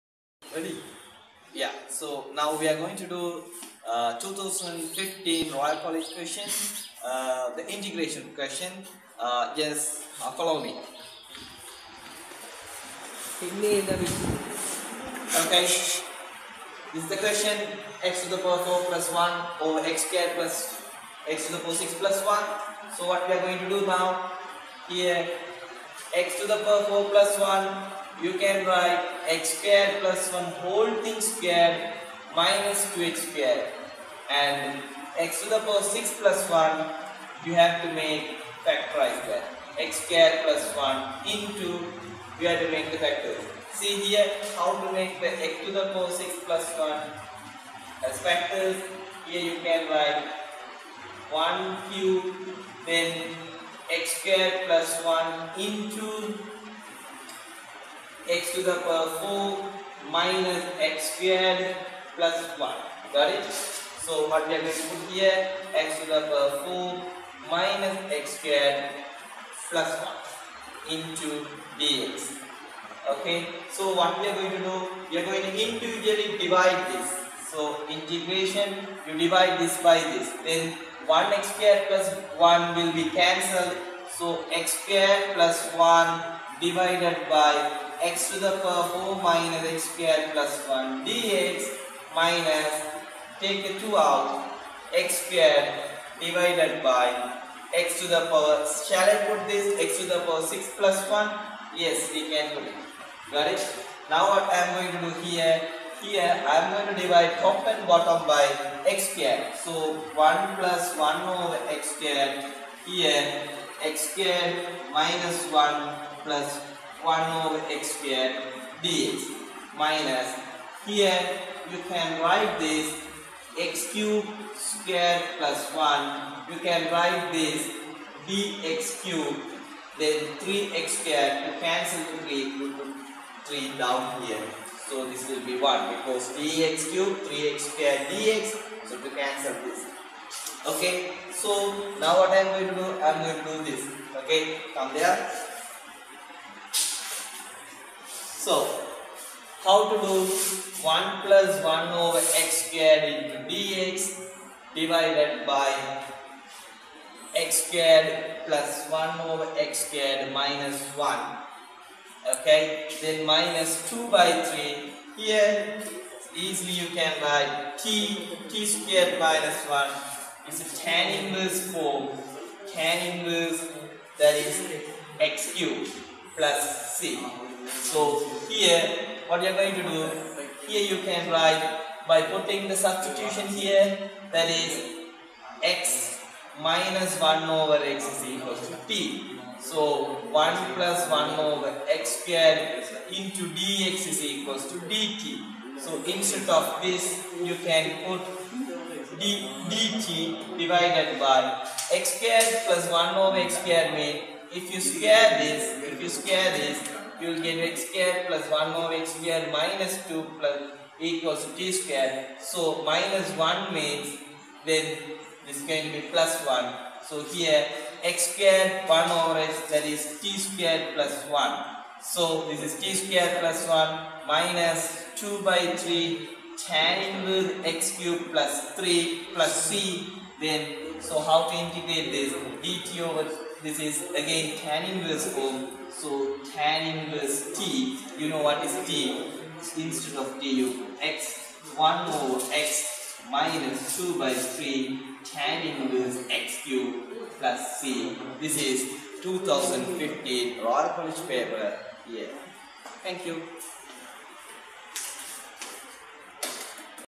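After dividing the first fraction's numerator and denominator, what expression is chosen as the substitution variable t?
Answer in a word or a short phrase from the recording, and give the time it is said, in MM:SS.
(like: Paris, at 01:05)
x minus 1 over x, at 03:05.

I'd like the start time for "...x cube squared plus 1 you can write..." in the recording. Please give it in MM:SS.
02:03.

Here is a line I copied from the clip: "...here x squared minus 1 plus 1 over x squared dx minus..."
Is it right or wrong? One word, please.
right.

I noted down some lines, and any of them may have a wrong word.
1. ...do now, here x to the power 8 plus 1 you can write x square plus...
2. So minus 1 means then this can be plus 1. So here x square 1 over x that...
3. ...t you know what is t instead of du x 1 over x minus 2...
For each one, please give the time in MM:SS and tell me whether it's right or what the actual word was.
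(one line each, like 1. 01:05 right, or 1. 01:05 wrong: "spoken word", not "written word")
1. 00:23 wrong: "4", not "8"
2. 03:32 right
3. 03:57 right.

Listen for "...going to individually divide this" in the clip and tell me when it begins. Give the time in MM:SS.
01:15.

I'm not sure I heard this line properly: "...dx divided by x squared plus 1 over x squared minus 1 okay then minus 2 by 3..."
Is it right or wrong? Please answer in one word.
right.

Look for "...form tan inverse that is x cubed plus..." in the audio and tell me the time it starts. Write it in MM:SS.
02:51.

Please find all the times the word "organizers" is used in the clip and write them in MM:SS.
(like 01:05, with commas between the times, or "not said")
not said.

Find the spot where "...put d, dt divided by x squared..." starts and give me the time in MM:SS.
03:18.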